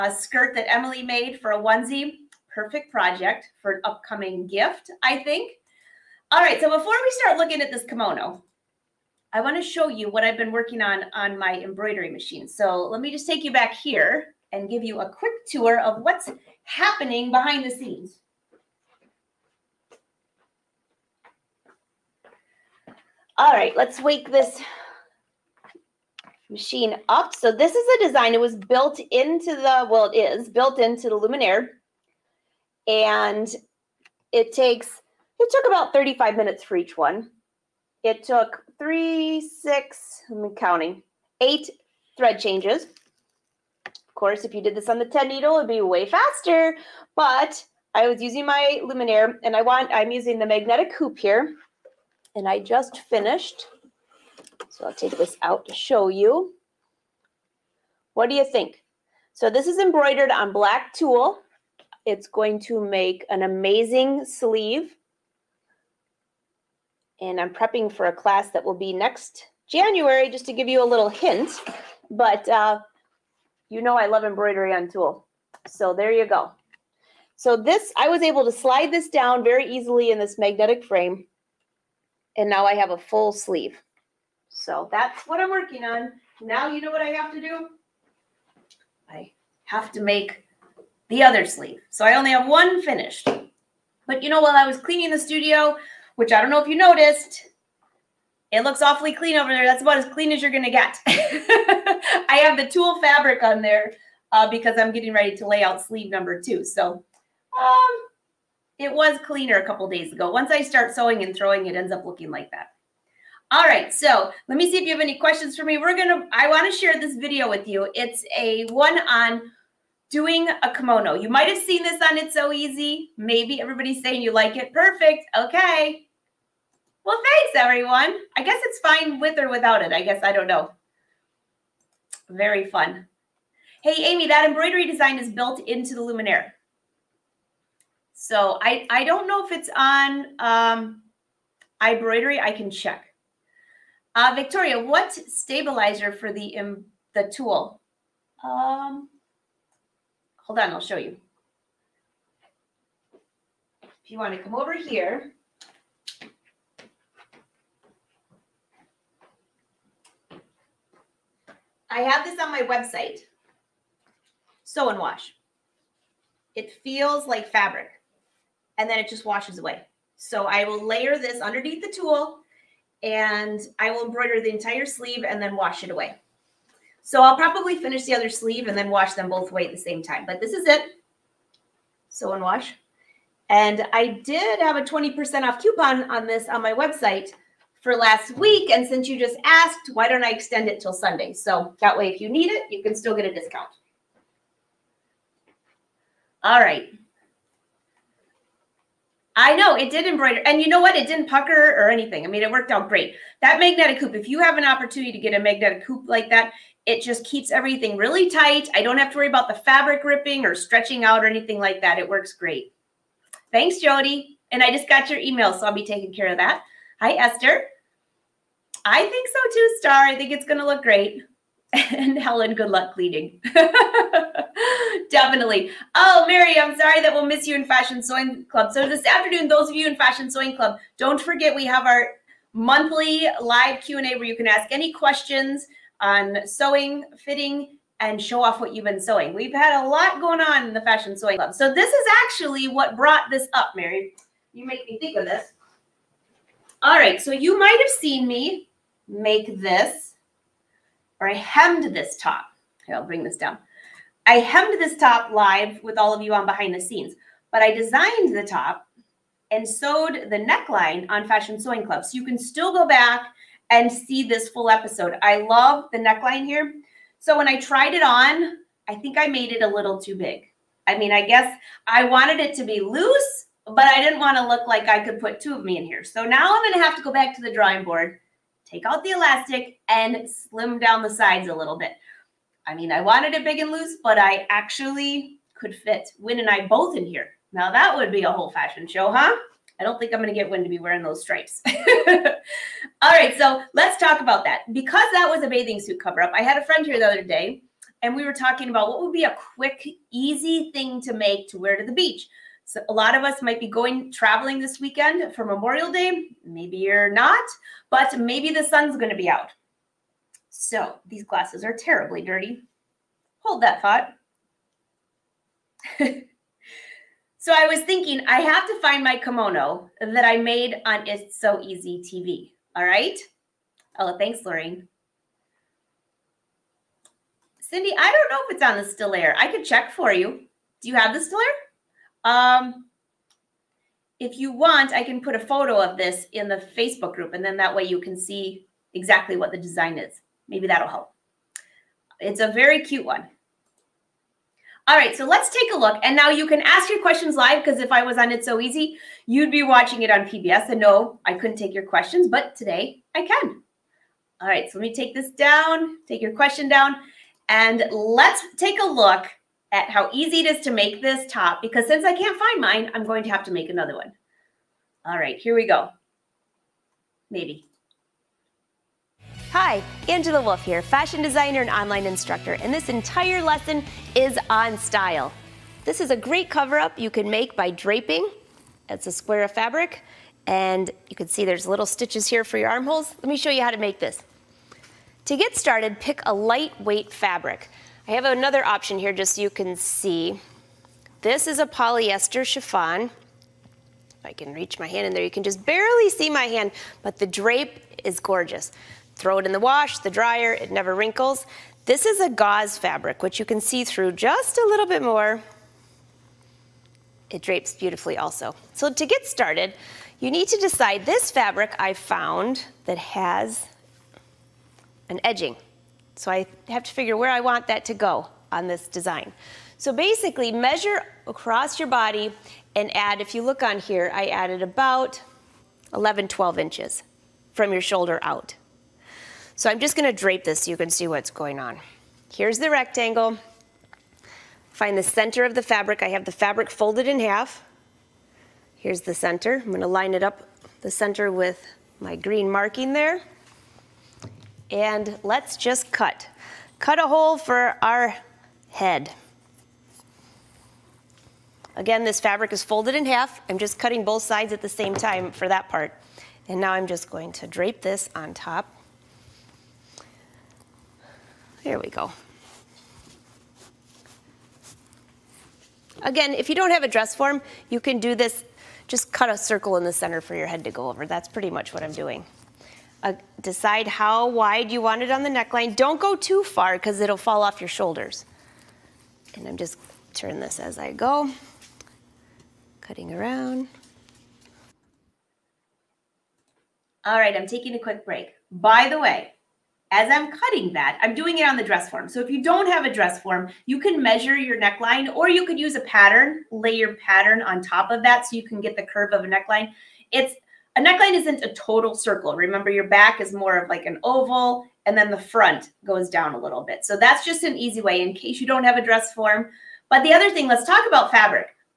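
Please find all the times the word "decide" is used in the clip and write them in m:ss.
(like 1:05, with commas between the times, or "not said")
6:50, 7:53.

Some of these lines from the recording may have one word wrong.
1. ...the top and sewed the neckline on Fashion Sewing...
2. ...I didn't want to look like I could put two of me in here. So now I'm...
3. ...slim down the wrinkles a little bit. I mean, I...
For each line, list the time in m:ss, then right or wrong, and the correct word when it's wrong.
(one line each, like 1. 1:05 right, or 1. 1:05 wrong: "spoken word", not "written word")
1. 4:18 right
2. 4:33 right
3. 4:40 wrong: "sides", not "wrinkles".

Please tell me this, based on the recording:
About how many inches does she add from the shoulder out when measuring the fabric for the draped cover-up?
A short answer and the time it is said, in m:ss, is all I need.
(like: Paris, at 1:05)
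11 to 12 inches, at 7:05.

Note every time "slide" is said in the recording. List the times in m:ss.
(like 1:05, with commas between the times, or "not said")
1:18.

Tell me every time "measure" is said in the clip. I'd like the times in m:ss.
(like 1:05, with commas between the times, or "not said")
7:00, 8:14.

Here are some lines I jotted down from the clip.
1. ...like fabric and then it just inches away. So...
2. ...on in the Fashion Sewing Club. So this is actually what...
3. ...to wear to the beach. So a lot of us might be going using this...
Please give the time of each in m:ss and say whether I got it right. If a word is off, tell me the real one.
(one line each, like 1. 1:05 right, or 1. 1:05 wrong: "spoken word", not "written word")
1. 2:47 wrong: "washes", not "inches"
2. 4:00 right
3. 5:01 wrong: "traveling", not "using".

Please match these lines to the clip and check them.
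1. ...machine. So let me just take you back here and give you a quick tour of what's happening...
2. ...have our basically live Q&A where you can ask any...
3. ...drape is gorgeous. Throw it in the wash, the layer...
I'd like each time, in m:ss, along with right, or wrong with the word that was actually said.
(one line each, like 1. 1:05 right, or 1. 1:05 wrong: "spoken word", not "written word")
1. 0:12 right
2. 3:51 wrong: "monthly", not "basically"
3. 6:37 wrong: "dryer", not "layer".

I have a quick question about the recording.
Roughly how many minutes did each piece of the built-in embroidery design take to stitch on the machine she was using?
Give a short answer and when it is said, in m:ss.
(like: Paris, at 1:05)
35, at 0:35.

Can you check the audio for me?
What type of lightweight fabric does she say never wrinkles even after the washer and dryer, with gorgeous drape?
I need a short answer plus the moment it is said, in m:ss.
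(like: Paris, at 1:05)
Polyester chiffon, at 6:31.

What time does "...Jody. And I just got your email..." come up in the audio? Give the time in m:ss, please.
3:33.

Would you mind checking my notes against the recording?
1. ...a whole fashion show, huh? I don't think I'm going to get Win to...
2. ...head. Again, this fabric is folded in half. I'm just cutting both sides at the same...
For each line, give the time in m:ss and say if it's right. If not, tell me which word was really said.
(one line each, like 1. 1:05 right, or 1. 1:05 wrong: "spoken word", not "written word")
1. 4:48 right
2. 7:28 right.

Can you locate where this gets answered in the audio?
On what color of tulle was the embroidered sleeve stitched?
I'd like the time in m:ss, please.
1:00.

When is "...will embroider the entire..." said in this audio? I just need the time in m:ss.
2:53.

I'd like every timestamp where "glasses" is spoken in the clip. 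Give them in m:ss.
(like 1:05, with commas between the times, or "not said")
5:11.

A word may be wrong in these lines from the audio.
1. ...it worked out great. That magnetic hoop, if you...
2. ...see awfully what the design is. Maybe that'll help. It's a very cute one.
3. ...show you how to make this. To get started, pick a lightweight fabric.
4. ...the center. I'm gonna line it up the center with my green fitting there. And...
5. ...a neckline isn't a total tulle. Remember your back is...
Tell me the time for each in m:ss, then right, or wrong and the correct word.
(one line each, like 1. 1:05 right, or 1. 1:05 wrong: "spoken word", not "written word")
1. 3:22 right
2. 5:38 wrong: "exactly", not "awfully"
3. 6:23 right
4. 7:19 wrong: "marking", not "fitting"
5. 8:20 wrong: "circle", not "tulle".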